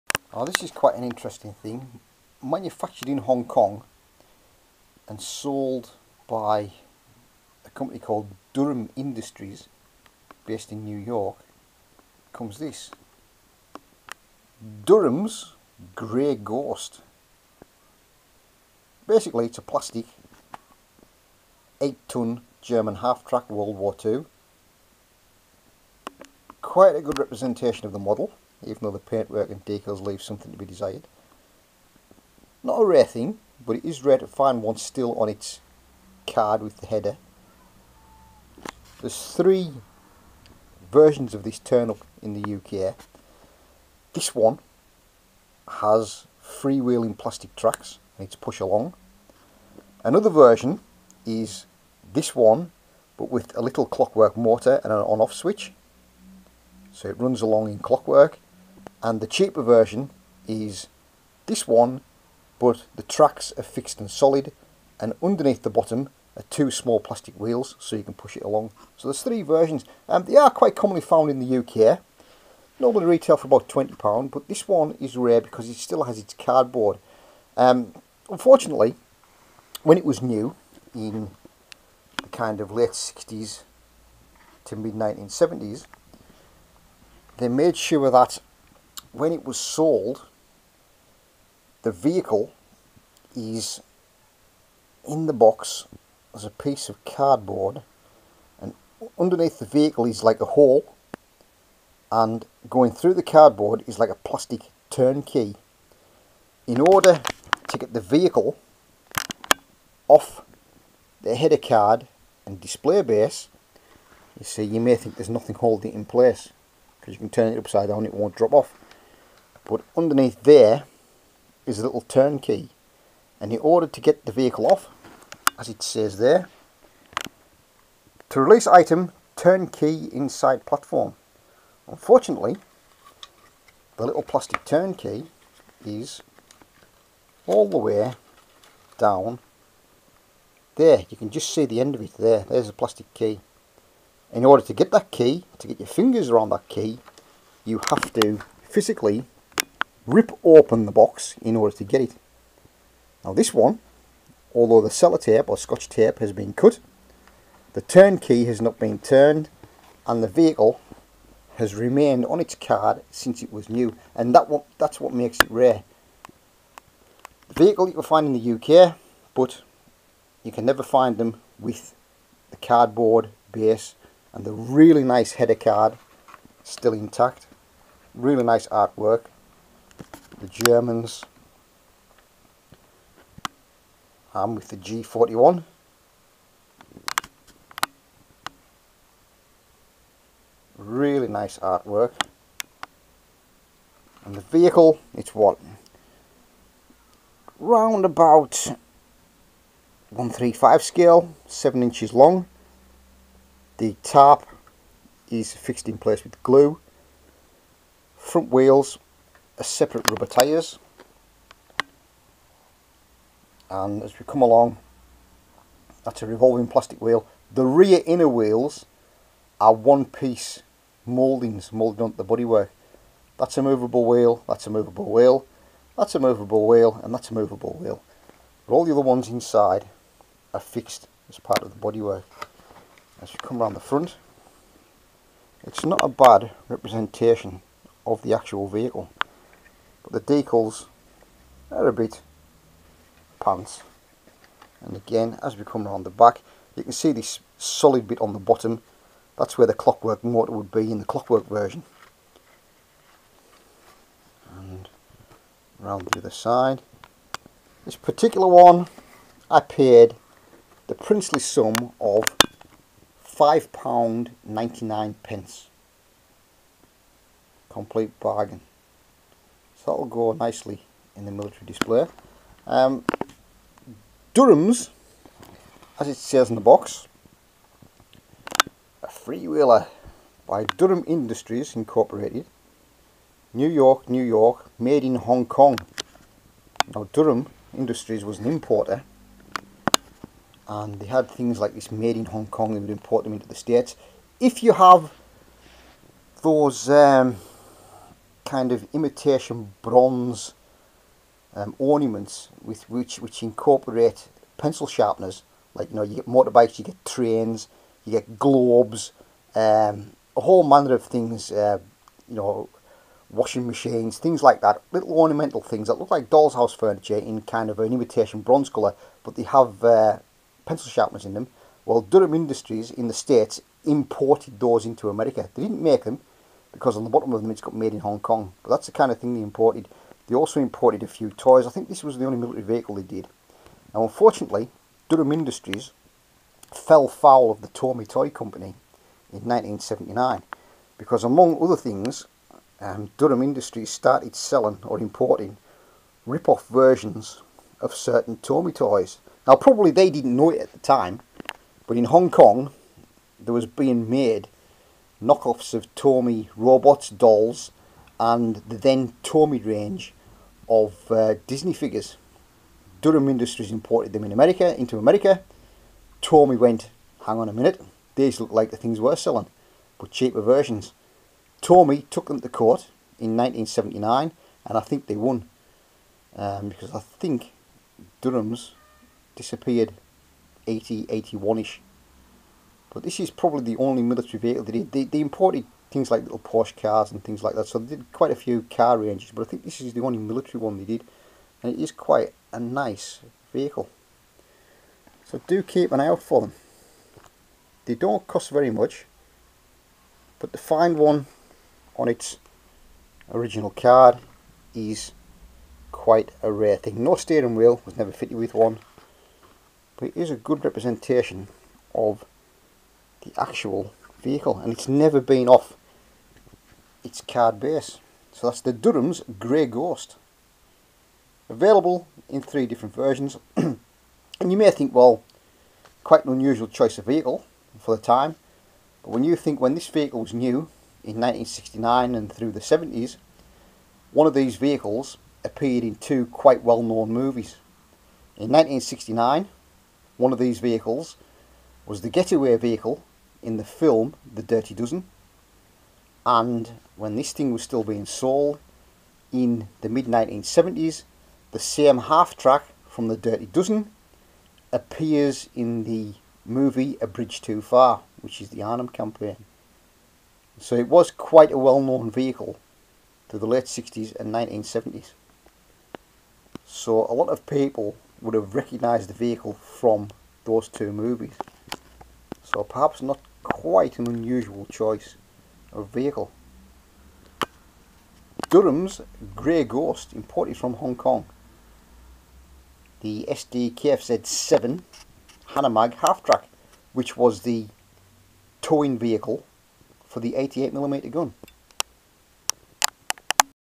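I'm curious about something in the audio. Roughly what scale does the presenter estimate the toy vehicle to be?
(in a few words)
1:35.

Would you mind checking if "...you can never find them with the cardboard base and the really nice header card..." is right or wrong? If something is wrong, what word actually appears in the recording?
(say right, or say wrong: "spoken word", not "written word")
right.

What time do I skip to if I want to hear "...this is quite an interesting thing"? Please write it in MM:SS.
00:00.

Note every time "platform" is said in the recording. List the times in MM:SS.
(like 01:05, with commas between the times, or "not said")
02:10.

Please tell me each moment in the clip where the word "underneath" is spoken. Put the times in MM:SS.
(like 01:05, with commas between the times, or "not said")
01:05, 01:39, 01:59.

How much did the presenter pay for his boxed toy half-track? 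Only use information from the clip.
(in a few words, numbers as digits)
£5.99.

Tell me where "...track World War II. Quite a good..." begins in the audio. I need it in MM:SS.
00:23.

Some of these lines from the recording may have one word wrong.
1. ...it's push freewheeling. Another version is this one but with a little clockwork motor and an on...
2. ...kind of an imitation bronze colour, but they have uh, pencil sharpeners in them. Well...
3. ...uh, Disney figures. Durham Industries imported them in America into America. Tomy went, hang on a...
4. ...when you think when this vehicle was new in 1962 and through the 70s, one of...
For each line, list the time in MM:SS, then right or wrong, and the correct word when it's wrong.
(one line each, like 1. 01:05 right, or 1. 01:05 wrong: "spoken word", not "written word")
1. 00:48 wrong: "along", not "freewheeling"
2. 05:17 right
3. 06:01 right
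4. 07:09 wrong: "1969", not "1962".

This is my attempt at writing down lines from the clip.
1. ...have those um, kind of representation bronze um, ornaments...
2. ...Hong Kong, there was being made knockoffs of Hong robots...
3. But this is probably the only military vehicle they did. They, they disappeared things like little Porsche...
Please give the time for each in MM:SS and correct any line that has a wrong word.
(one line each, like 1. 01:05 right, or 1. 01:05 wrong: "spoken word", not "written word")
1. 04:54 wrong: "imitation", not "representation"
2. 05:52 wrong: "Tomy", not "Hong"
3. 06:22 wrong: "imported", not "disappeared".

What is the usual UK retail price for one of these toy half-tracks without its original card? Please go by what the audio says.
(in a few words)
£20.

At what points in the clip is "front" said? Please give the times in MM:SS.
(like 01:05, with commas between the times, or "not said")
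03:28, 03:53.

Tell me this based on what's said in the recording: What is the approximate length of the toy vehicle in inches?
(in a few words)
7 inches.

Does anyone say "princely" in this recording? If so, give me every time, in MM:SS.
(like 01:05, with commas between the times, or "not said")
04:20.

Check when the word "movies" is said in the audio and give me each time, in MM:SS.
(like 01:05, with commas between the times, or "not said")
07:17, 07:36, 07:50.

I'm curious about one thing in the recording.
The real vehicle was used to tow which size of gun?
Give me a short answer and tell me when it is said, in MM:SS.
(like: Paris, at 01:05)
88mm, at 08:10.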